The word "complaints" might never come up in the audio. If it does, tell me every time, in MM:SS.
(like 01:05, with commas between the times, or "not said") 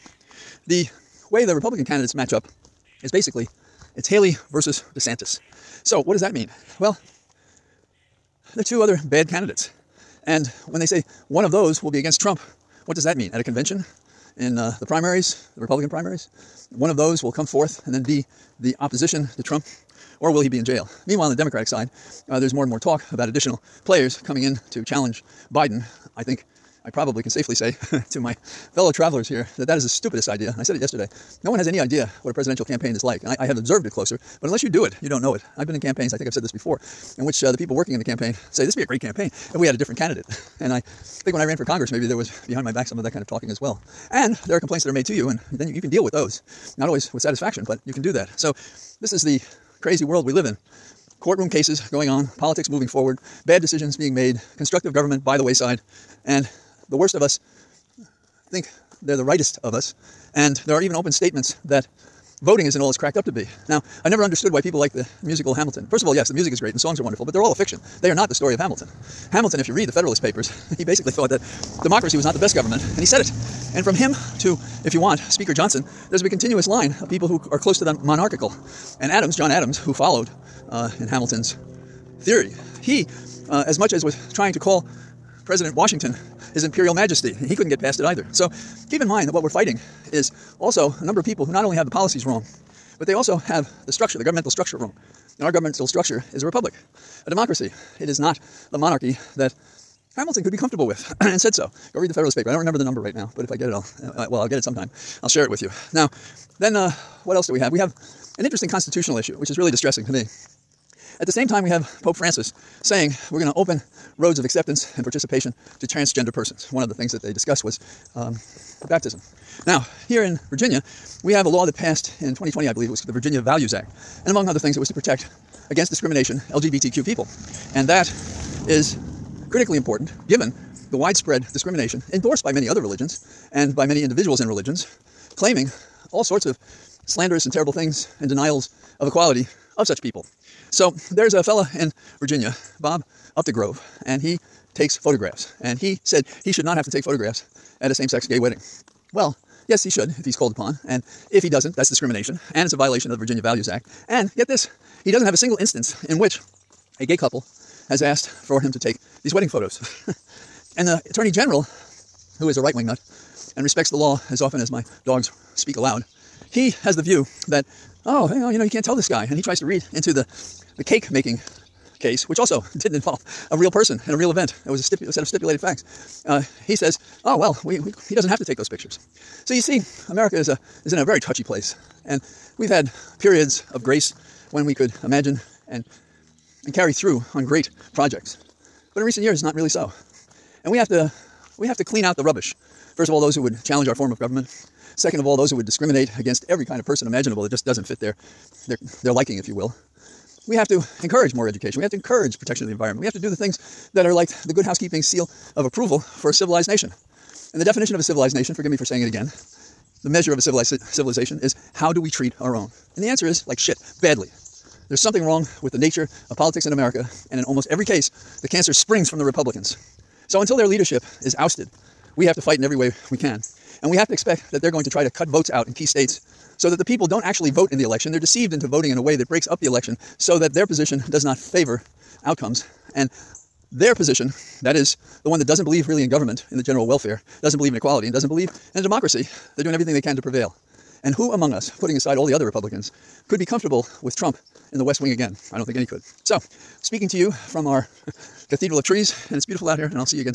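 00:44.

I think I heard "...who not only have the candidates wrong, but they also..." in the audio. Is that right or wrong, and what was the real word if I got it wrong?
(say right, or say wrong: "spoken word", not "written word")
wrong: "policies", not "candidates".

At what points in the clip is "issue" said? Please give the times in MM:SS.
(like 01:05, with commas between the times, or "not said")
01:49.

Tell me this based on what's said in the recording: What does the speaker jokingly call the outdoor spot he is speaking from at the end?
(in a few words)
Cathedral of Trees.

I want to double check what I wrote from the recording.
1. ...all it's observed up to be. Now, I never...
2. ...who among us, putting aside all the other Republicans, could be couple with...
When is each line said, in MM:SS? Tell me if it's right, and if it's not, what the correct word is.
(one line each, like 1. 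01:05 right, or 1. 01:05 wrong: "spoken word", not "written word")
1. 01:02 wrong: "cracked", not "observed"
2. 04:01 wrong: "comfortable", not "couple".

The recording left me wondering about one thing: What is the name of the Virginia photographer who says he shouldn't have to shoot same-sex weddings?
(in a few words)
Bob Updegrove.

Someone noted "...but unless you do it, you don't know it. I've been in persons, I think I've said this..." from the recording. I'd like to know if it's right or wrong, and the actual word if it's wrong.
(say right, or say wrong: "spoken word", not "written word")
wrong: "campaigns", not "persons".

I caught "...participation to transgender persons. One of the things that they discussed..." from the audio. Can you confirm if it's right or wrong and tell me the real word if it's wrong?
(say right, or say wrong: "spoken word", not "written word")
right.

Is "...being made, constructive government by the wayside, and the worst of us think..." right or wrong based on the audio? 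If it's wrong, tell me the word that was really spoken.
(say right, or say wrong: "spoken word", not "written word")
right.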